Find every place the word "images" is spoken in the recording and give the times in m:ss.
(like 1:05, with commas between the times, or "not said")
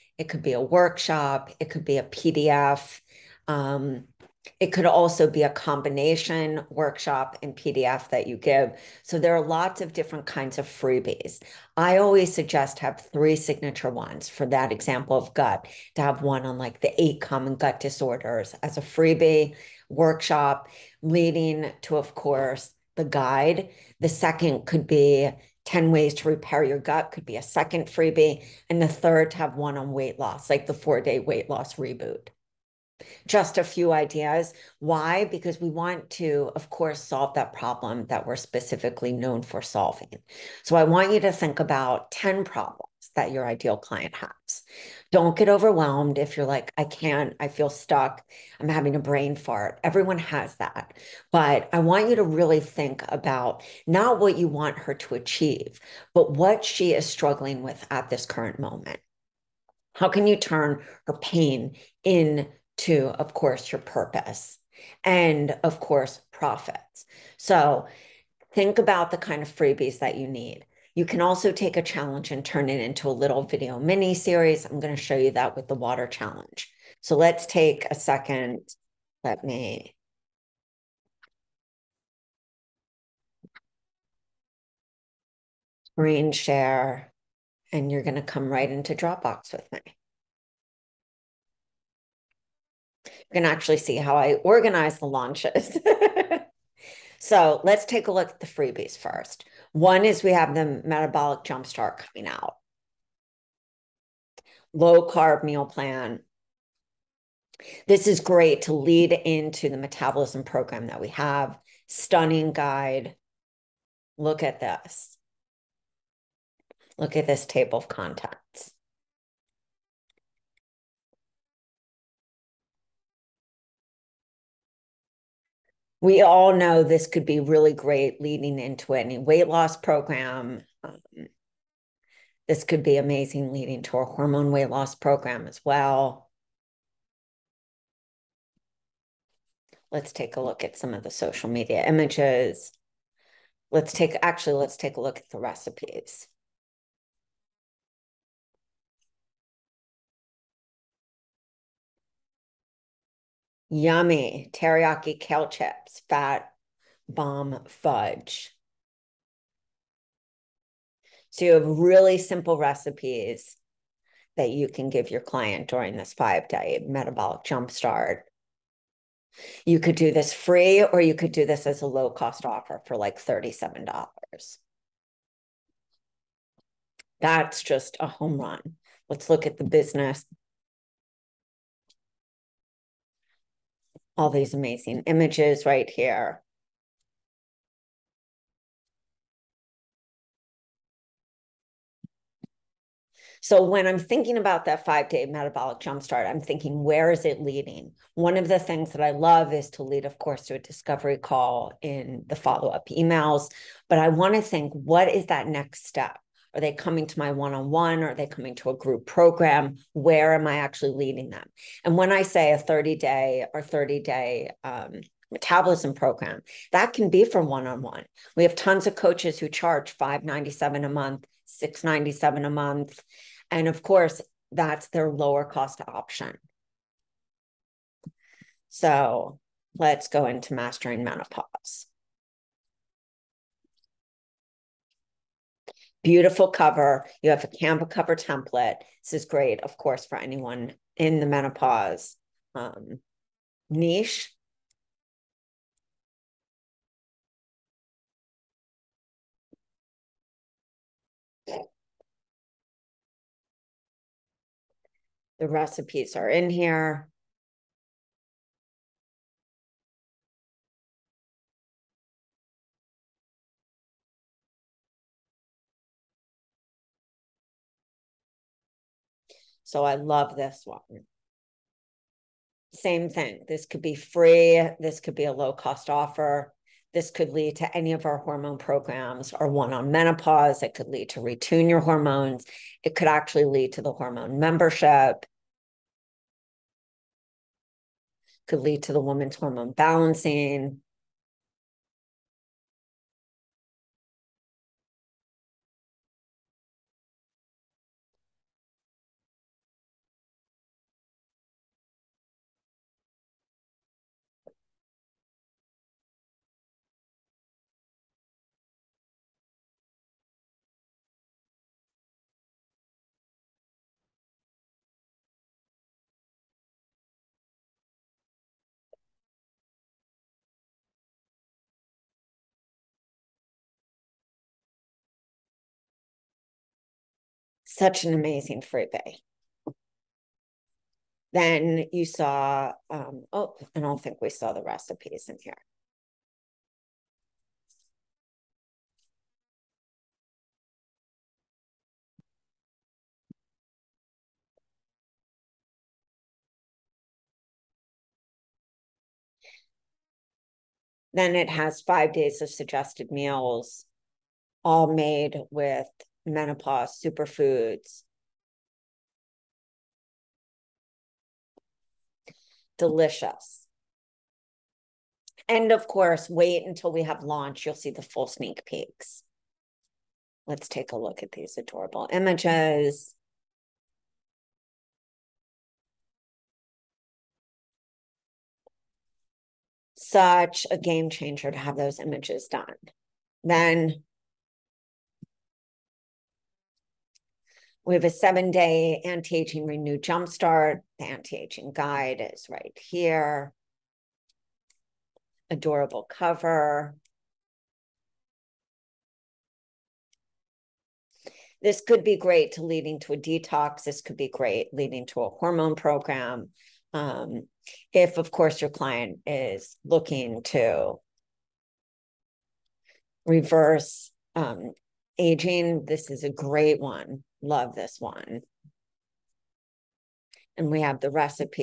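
2:21, 3:05, 6:12, 6:21.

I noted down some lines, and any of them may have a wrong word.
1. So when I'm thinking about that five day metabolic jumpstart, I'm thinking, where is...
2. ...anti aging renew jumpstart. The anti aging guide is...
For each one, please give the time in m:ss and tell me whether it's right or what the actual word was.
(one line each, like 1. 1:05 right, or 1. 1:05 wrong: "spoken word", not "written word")
1. 3:13 right
2. 6:29 right.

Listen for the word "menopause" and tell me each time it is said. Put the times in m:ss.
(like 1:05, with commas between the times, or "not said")
3:51, 4:01, 4:39, 5:56.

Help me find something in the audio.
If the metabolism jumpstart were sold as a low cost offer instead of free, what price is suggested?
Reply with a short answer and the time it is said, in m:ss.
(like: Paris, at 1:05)
$37, at 2:53.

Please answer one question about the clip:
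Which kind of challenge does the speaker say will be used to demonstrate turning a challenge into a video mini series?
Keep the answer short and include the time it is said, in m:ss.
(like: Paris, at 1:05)
water challenge, at 1:15.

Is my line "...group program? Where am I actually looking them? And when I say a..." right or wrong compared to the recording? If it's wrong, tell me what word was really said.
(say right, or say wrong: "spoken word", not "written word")
wrong: "leading", not "looking".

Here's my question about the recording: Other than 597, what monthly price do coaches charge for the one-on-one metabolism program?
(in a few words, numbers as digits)
$697.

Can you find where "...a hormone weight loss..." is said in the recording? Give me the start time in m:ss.
2:13.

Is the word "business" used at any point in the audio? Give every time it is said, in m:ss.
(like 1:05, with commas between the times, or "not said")
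2:59.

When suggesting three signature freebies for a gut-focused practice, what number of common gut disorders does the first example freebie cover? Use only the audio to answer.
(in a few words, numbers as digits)
8.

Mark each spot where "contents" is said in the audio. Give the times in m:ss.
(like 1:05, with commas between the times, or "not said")
1:57.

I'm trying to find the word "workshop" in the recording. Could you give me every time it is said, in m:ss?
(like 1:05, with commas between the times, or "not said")
0:00, 0:06, 0:19.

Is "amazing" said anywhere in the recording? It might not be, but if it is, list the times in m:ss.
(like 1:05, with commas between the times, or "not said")
2:12, 3:04, 5:28.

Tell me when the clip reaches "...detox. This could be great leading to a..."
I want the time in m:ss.
6:43.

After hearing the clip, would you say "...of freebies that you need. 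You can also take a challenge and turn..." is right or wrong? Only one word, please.
right.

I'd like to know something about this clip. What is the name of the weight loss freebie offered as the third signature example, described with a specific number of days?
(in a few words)
four day weight loss reboot.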